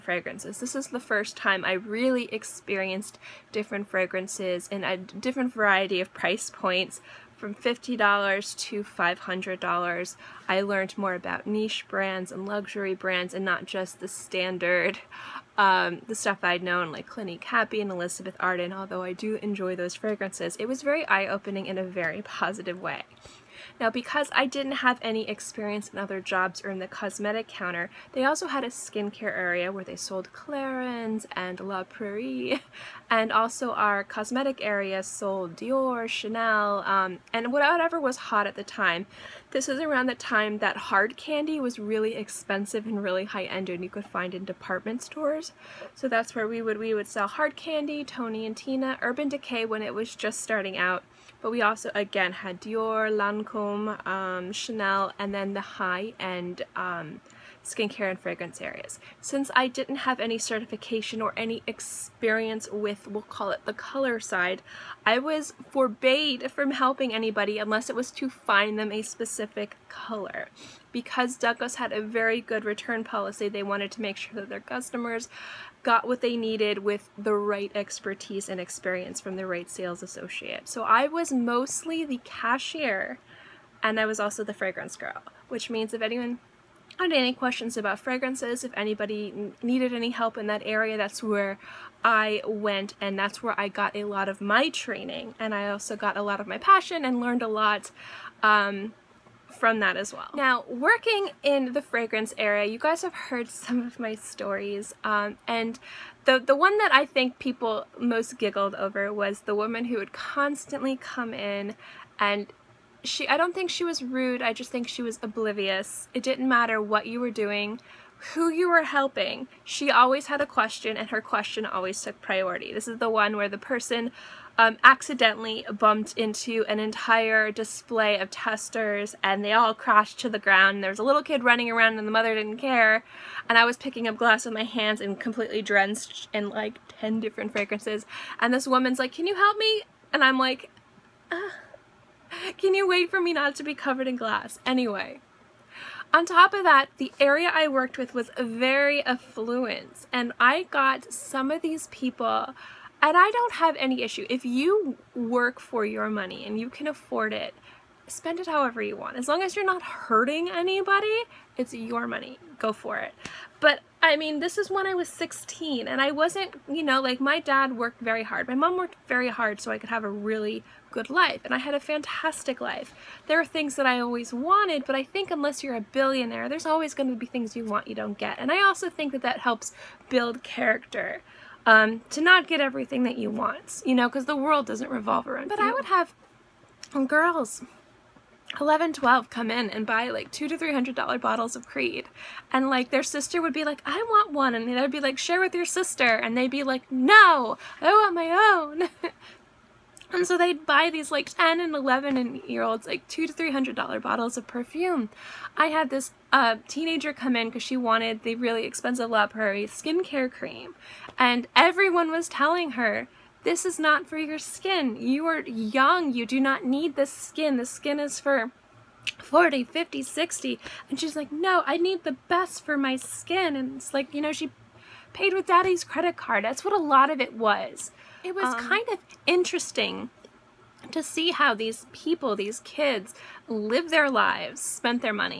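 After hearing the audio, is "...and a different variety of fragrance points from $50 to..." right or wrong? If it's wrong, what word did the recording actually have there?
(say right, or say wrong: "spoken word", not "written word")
wrong: "price", not "fragrance".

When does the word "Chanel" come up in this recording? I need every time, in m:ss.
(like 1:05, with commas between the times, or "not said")
0:36, 0:54.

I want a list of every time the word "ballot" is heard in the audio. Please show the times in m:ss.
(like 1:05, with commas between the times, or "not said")
not said.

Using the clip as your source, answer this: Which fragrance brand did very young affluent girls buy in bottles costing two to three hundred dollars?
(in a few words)
Creed.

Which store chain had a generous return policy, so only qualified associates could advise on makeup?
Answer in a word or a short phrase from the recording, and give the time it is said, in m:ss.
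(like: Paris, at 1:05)
Douglas, at 1:11.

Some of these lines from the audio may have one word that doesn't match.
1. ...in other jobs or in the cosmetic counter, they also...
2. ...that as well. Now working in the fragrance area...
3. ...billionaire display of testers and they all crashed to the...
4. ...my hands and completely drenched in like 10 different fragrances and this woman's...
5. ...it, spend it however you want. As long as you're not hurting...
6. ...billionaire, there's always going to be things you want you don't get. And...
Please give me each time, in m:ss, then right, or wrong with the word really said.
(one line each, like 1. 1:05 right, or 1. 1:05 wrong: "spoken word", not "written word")
1. 0:25 right
2. 1:39 right
3. 2:06 wrong: "entire", not "billionaire"
4. 2:14 right
5. 2:37 right
6. 2:55 right.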